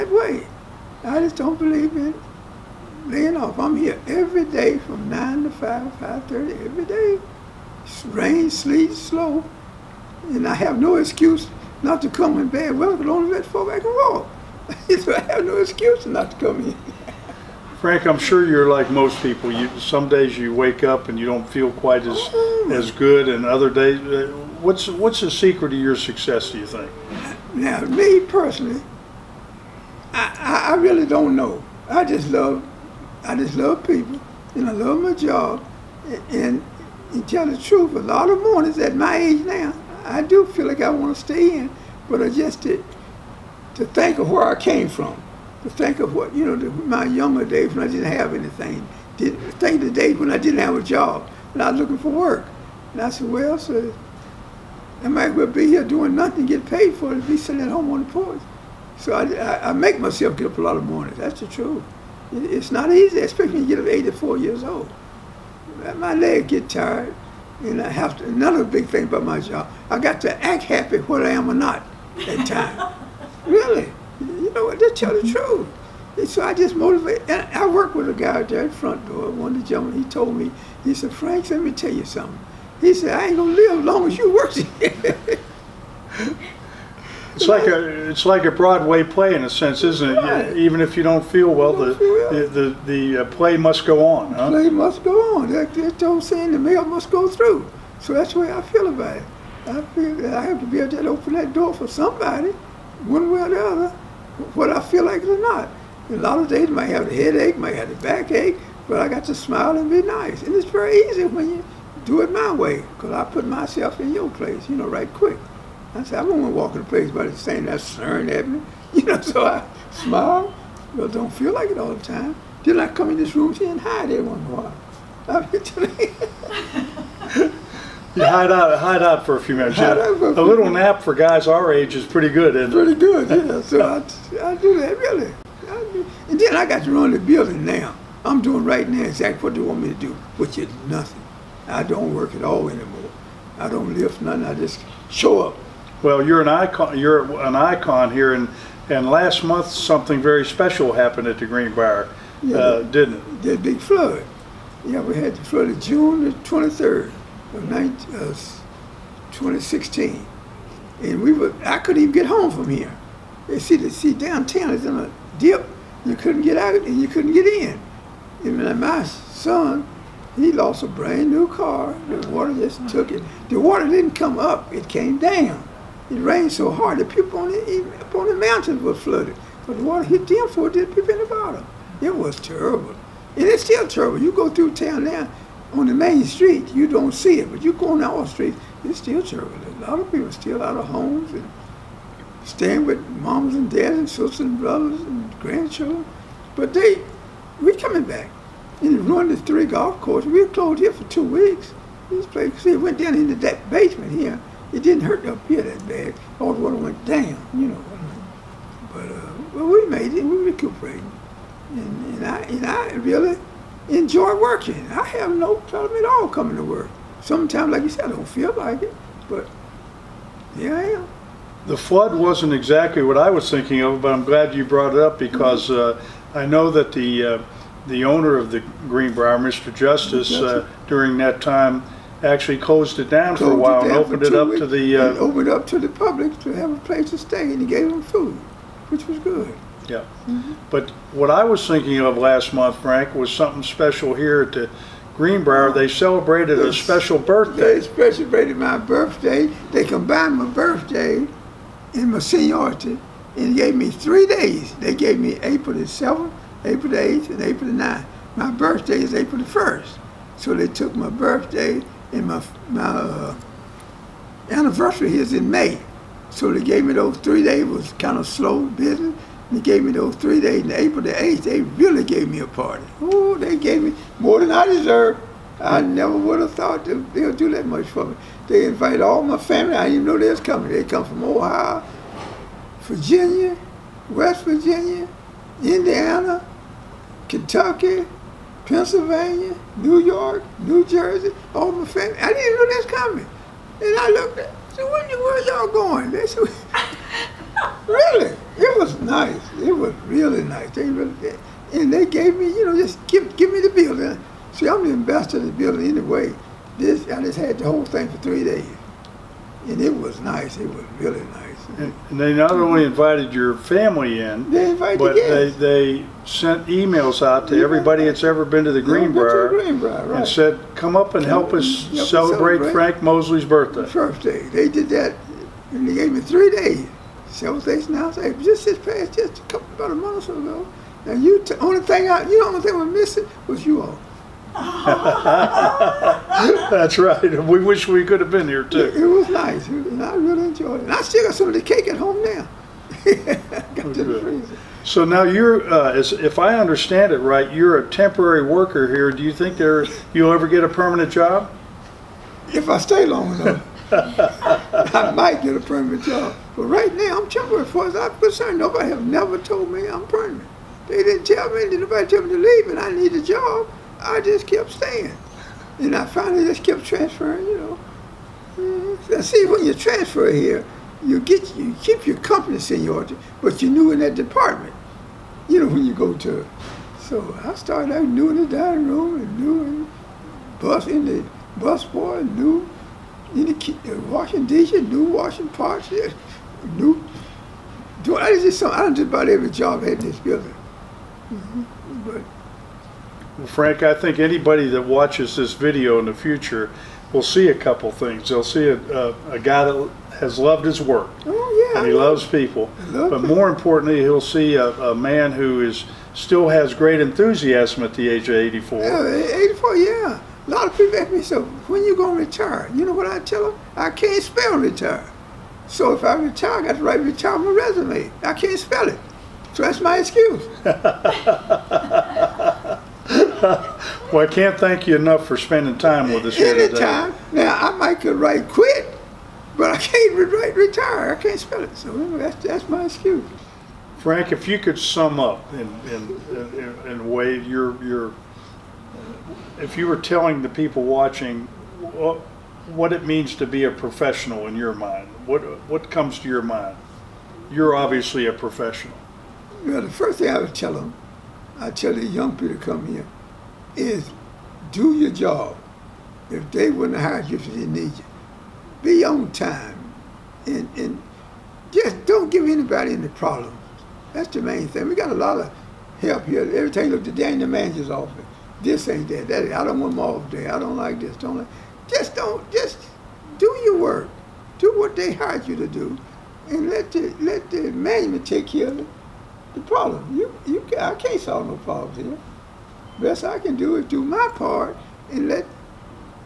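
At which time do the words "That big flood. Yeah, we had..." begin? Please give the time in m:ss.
2:33.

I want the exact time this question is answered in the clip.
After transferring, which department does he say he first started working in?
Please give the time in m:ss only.
6:18.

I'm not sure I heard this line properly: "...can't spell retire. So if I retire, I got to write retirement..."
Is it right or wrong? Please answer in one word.
right.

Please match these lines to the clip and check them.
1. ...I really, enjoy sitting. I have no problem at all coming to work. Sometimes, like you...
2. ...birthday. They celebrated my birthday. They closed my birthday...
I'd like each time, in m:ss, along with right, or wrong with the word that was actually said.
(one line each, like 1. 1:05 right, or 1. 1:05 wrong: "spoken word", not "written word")
1. 3:32 wrong: "working", not "sitting"
2. 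4:07 wrong: "combined", not "closed".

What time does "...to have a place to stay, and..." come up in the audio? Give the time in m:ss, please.
3:56.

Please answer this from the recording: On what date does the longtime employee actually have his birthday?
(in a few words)
April 1.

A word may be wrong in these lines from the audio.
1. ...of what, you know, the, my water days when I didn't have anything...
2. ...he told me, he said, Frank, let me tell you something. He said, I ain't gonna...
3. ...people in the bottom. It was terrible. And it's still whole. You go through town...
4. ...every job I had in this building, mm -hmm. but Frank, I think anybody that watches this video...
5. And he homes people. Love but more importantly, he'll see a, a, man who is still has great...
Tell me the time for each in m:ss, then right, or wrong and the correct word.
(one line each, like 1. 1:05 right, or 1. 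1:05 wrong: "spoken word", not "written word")
1. 0:45 wrong: "younger", not "water"
2. 1:20 right
3. 3:00 wrong: "terrible", not "whole"
4. 6:29 right
5. 6:41 wrong: "loves", not "homes".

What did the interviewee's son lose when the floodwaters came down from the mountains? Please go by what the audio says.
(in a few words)
A brand new car.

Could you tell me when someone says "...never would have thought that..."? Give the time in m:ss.
4:35.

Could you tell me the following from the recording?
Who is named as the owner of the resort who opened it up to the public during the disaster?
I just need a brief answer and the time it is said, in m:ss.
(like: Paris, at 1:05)
Mr. Justice, at 3:49.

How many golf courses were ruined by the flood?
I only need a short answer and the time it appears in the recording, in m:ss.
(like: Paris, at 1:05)
3, at 3:19.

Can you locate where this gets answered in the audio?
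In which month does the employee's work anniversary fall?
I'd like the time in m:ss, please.
4:25.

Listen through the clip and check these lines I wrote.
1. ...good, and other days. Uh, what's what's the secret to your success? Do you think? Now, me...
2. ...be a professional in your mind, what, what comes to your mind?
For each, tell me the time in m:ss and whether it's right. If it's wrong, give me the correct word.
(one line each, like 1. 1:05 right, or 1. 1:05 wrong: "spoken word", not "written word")
1. 0:22 right
2. 7:23 right.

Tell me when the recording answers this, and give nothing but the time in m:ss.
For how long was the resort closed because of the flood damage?
3:21.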